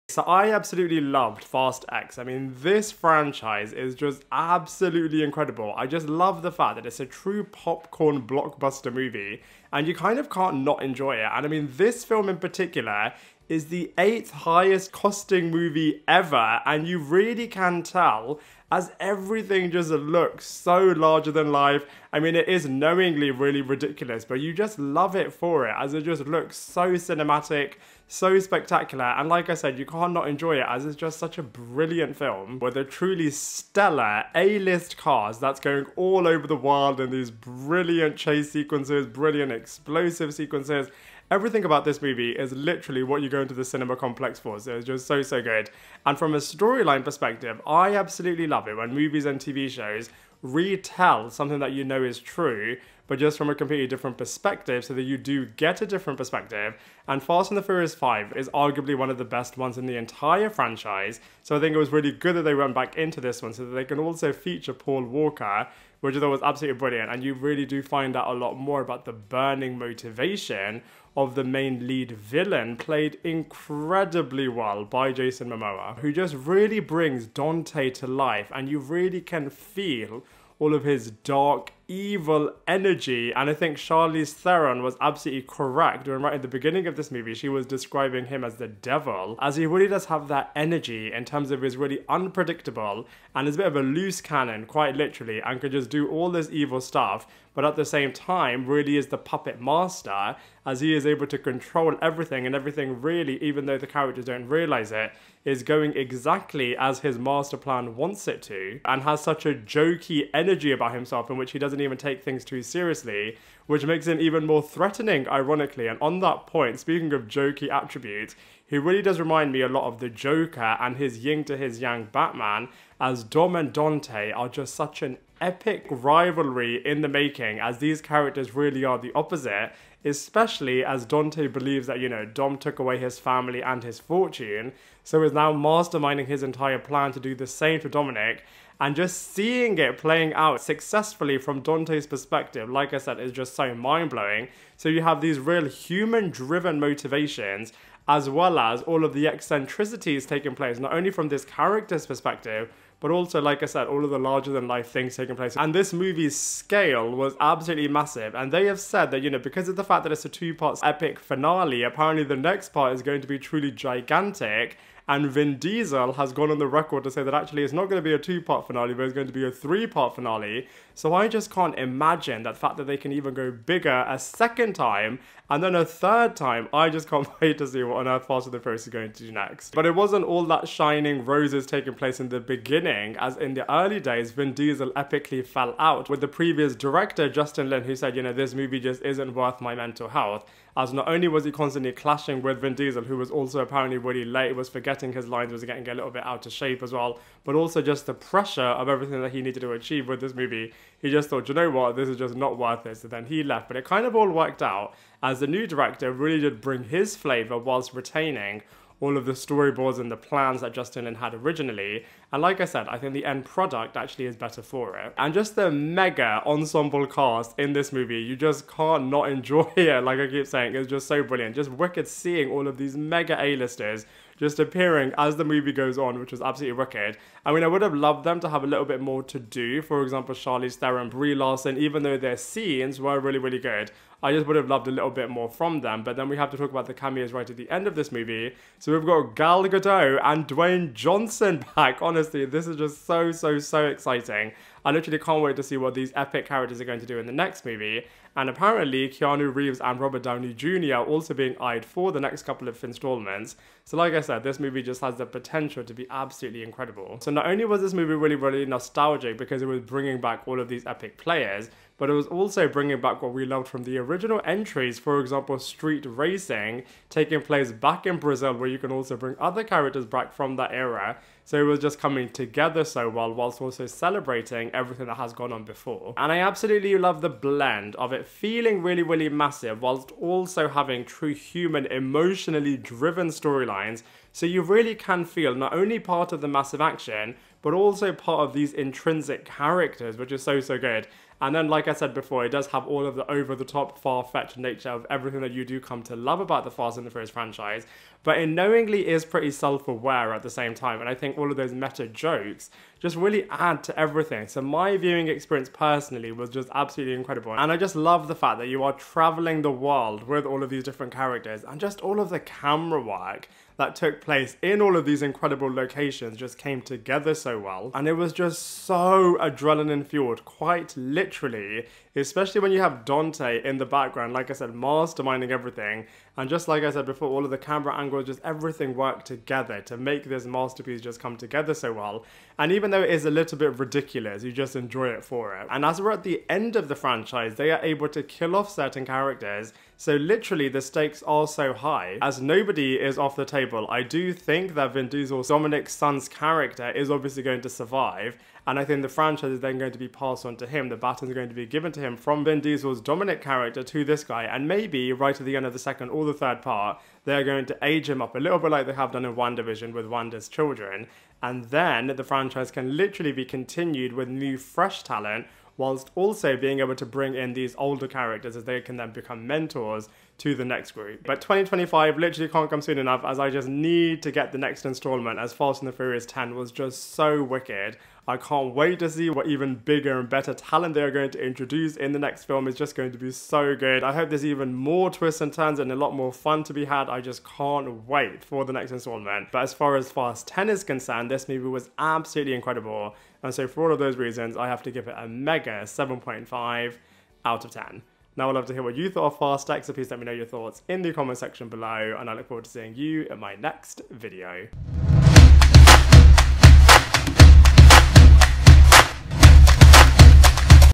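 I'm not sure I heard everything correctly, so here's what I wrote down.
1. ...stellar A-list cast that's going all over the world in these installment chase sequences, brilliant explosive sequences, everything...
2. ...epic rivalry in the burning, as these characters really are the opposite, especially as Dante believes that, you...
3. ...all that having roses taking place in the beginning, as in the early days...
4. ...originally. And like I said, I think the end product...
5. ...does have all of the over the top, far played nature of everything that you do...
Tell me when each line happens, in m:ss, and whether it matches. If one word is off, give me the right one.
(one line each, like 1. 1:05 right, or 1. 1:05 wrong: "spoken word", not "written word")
1. 0:33 wrong: "brilliant", not "installment"
2. 2:05 wrong: "making", not "burning"
3. 3:00 wrong: "shining", not "having"
4. 3:31 right
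5. 4:52 wrong: "fetched", not "played".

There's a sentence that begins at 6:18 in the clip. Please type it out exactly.
I can't wait to see what even bigger and better talent they are going to introduce in the next film.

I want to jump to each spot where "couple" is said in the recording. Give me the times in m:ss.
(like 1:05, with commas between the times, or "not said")
4:12.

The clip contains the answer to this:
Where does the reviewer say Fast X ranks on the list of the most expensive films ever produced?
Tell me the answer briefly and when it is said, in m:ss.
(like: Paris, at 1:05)
eighth, at 0:13.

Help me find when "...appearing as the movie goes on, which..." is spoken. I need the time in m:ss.
3:44.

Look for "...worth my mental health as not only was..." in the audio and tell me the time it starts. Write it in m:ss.
3:09.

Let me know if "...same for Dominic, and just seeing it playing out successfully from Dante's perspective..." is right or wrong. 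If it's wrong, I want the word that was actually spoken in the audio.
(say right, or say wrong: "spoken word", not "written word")
right.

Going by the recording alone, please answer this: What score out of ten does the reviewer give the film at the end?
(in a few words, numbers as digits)
7.5.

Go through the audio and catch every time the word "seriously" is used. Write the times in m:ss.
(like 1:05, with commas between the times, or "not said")
1:52.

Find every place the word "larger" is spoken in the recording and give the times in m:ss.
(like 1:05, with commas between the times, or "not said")
0:20, 2:34.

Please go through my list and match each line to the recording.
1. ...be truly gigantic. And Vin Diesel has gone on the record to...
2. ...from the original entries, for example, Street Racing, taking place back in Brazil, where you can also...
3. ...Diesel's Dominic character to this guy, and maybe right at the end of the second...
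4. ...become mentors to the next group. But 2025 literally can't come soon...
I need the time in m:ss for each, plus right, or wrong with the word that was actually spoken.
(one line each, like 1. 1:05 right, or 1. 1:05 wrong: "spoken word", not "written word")
1. 2:43 right
2. 4:23 right
3. 5:52 right
4. 6:09 right.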